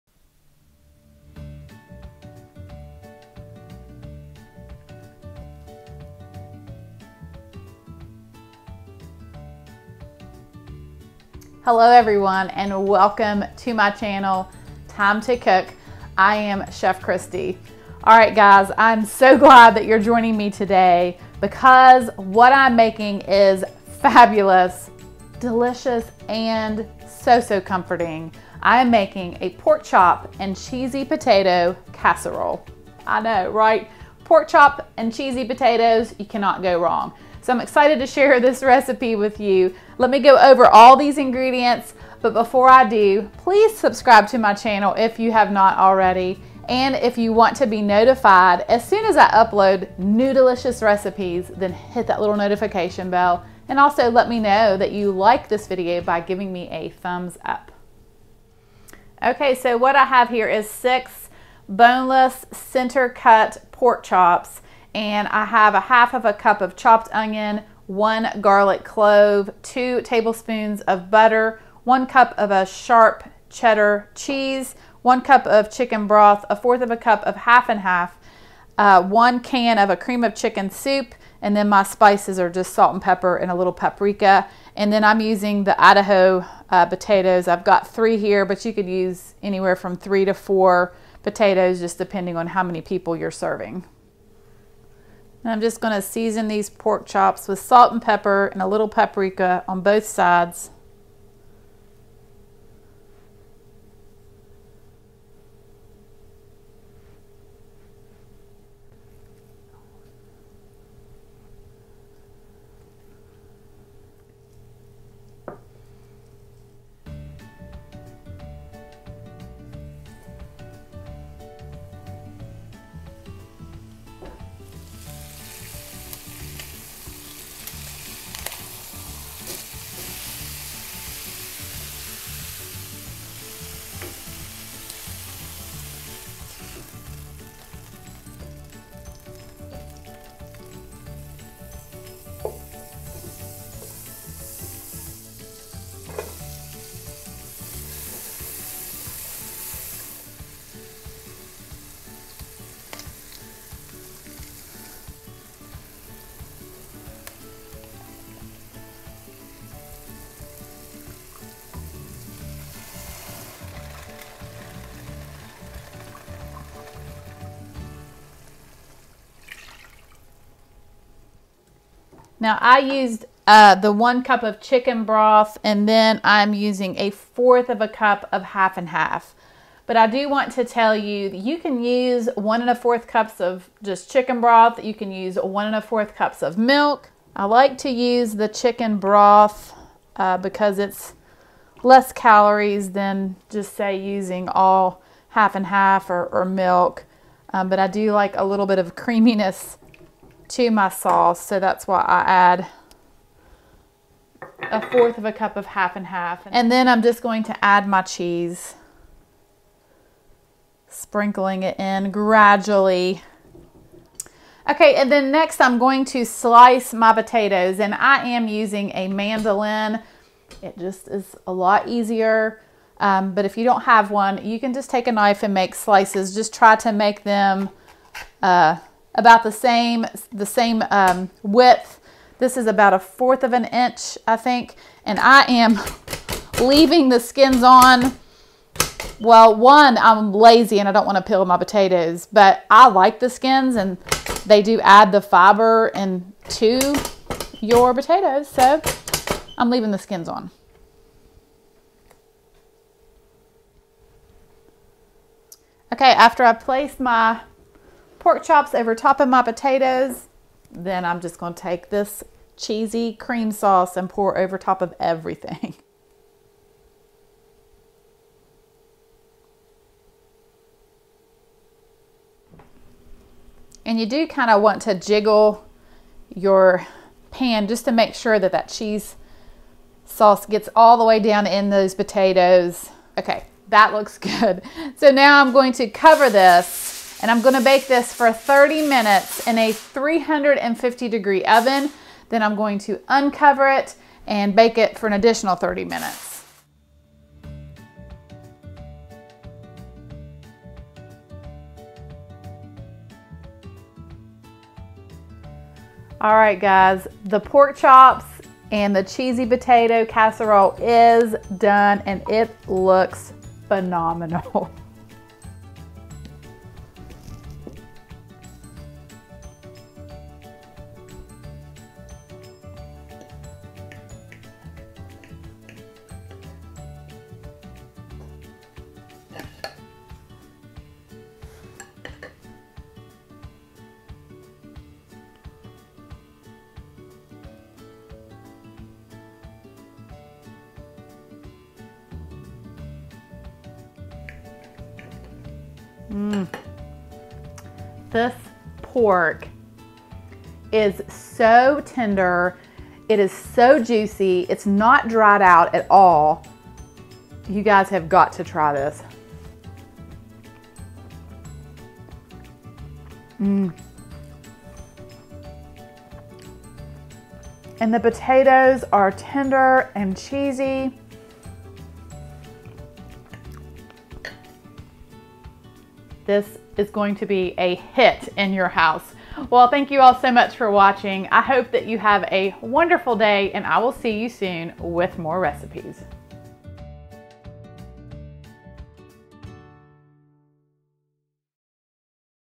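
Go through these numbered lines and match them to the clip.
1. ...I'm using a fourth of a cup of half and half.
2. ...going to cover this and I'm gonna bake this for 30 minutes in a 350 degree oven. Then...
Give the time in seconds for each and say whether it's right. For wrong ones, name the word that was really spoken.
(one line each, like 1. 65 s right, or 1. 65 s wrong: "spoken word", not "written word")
1. 176 s right
2. 285 s right.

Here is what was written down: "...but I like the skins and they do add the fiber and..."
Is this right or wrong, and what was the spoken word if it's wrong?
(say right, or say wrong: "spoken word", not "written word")
right.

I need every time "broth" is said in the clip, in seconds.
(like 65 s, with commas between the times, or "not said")
76 s, 175 s, 184 s, 188 s.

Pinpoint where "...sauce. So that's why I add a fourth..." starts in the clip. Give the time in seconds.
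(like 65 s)
200 s.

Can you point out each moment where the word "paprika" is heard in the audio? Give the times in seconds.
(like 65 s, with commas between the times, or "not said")
83 s, 98 s.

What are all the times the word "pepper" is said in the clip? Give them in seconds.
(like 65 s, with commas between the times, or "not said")
83 s, 98 s.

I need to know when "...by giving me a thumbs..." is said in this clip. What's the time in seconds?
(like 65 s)
56 s.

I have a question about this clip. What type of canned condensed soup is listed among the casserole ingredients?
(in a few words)
cream of chicken.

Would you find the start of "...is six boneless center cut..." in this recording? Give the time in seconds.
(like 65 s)
60 s.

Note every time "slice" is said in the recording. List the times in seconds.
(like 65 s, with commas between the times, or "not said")
216 s, 225 s.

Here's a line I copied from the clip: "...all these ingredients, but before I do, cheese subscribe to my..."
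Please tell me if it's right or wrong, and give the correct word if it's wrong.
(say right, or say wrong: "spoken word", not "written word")
wrong: "please", not "cheese".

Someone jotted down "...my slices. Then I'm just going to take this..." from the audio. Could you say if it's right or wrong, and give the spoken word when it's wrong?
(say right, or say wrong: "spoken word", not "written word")
wrong: "potatoes", not "slices".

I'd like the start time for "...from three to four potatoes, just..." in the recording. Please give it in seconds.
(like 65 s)
89 s.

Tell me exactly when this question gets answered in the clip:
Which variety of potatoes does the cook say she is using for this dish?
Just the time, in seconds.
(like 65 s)
85 s.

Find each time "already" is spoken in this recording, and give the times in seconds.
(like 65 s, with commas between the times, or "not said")
45 s.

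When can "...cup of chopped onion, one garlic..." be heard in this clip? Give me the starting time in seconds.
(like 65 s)
66 s.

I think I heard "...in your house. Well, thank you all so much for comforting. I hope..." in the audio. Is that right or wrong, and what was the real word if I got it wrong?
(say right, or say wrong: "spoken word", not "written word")
wrong: "watching", not "comforting".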